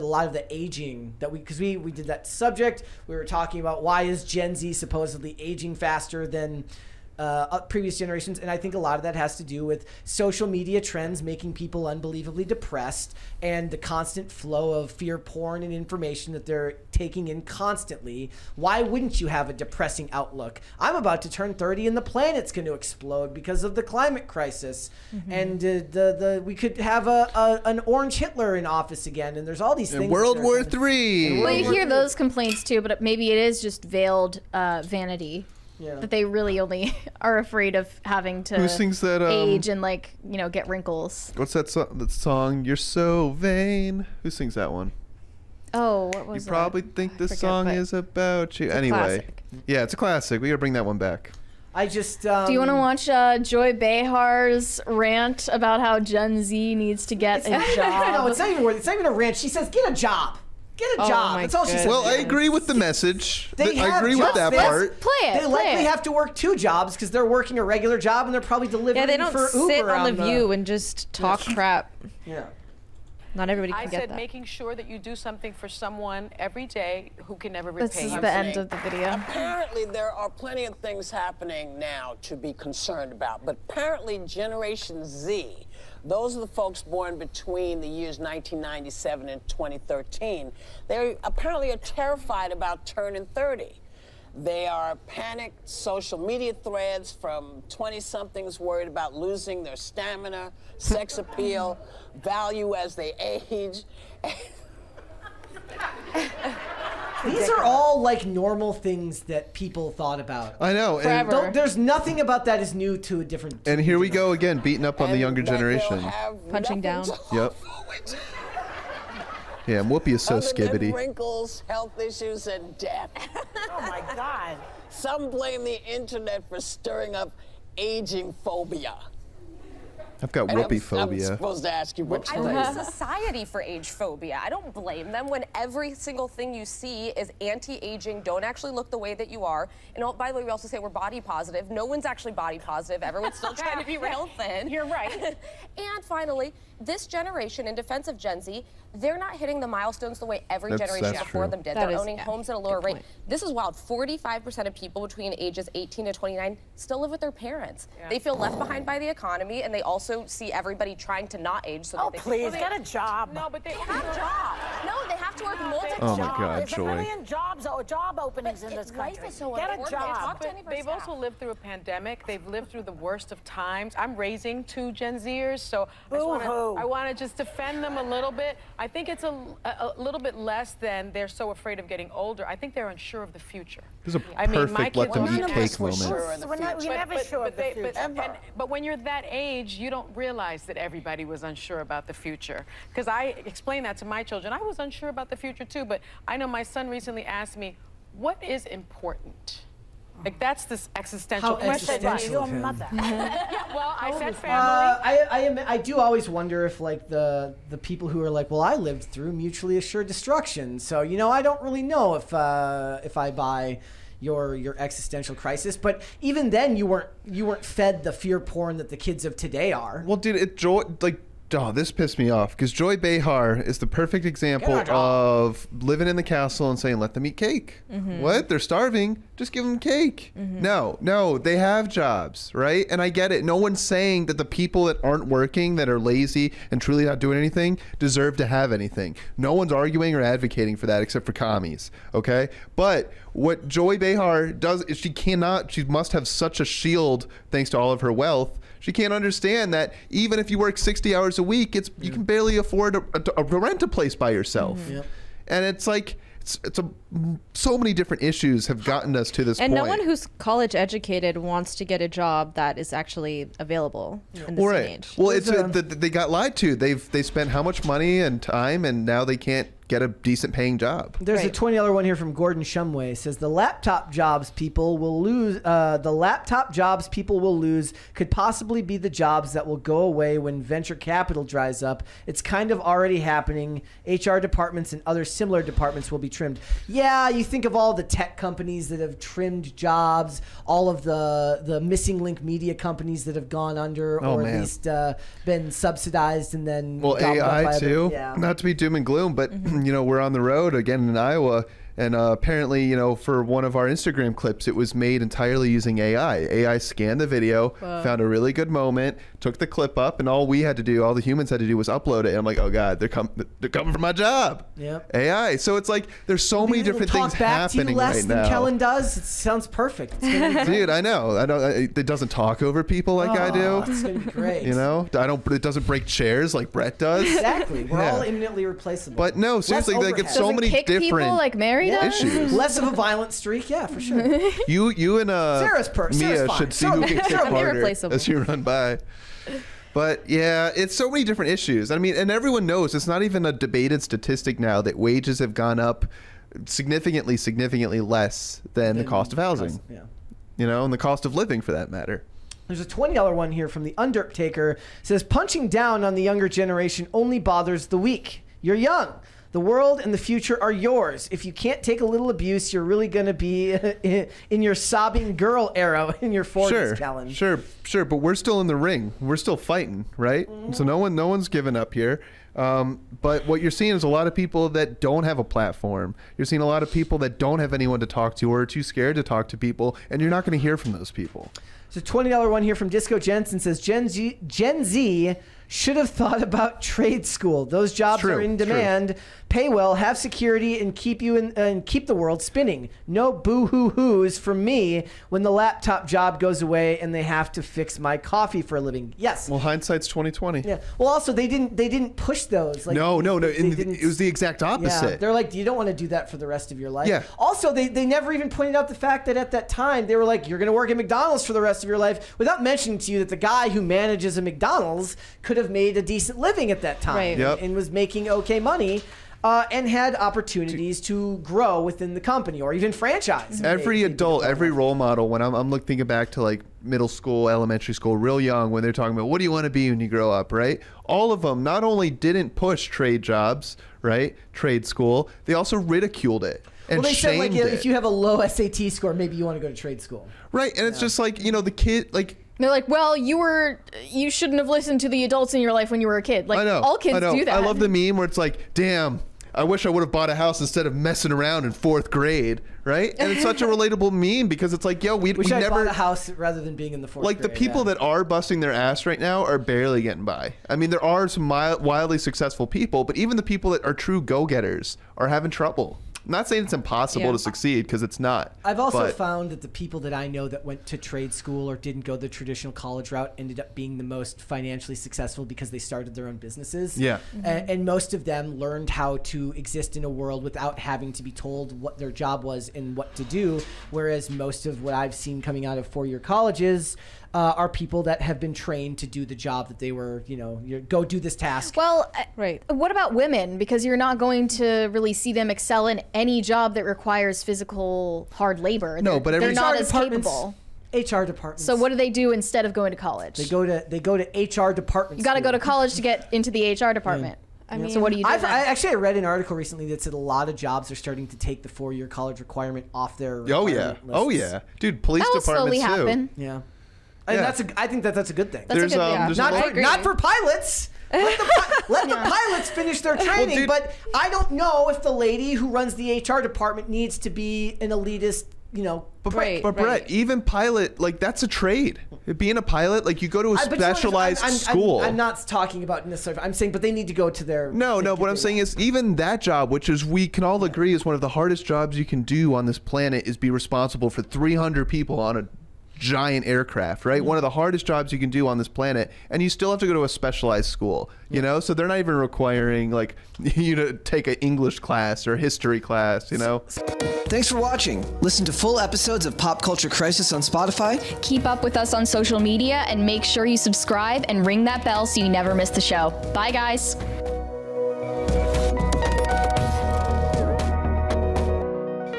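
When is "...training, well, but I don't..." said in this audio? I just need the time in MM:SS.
08:43.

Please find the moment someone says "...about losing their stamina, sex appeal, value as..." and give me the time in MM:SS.
01:38.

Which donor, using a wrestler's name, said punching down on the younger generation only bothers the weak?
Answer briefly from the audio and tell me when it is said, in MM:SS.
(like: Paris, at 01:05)
The Undertaker, at 05:53.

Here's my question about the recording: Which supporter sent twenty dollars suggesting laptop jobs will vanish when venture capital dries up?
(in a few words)
Gordon Shumway.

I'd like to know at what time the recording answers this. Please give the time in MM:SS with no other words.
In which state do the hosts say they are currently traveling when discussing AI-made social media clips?
05:01.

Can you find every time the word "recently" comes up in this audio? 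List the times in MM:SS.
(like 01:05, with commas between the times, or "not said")
03:16, 08:29.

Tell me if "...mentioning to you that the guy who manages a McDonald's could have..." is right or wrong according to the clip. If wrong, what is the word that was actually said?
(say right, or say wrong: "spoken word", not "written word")
right.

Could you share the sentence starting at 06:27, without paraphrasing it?
Those jobs true, are in demand.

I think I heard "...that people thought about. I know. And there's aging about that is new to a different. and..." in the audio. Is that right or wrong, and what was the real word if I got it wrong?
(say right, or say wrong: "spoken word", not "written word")
wrong: "nothing", not "aging".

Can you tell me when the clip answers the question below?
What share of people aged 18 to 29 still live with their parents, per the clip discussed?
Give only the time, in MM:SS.
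02:33.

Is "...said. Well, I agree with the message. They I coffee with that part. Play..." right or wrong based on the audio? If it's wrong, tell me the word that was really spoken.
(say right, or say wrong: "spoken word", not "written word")
wrong: "agree", not "coffee".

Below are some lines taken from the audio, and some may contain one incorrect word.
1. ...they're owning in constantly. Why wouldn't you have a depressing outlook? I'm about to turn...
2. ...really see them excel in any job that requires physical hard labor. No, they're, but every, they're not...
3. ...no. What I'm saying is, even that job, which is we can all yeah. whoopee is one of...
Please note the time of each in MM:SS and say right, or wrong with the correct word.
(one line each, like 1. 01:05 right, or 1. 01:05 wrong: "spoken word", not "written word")
1. 00:16 wrong: "taking", not "owning"
2. 08:14 right
3. 08:57 wrong: "agree", not "whoopee".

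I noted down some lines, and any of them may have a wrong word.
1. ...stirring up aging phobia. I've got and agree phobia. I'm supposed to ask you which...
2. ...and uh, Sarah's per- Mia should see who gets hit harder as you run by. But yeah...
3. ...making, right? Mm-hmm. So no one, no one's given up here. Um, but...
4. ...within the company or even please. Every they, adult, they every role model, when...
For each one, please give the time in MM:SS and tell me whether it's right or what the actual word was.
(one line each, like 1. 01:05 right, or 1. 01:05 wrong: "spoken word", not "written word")
1. 02:06 wrong: "whoopee", not "agree"
2. 05:35 right
3. 06:09 wrong: "fighting", not "making"
4. 07:01 wrong: "franchise", not "please".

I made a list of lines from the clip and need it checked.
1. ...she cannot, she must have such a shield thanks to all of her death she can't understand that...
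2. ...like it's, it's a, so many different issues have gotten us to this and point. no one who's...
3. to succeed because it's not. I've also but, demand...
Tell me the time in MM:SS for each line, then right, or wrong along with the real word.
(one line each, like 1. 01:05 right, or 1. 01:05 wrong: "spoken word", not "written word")
1. 04:04 wrong: "wealth", not "death"
2. 04:15 right
3. 07:47 wrong: "found", not "demand".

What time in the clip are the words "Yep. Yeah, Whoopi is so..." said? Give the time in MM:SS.
01:57.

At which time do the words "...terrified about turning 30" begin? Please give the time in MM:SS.
01:31.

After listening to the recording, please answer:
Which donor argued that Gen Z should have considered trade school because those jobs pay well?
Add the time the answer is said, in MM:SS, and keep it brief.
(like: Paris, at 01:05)
Disco Jensen, at 06:22.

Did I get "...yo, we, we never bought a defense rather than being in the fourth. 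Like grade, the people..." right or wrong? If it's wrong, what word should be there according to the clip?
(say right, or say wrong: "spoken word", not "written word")
wrong: "house", not "defense".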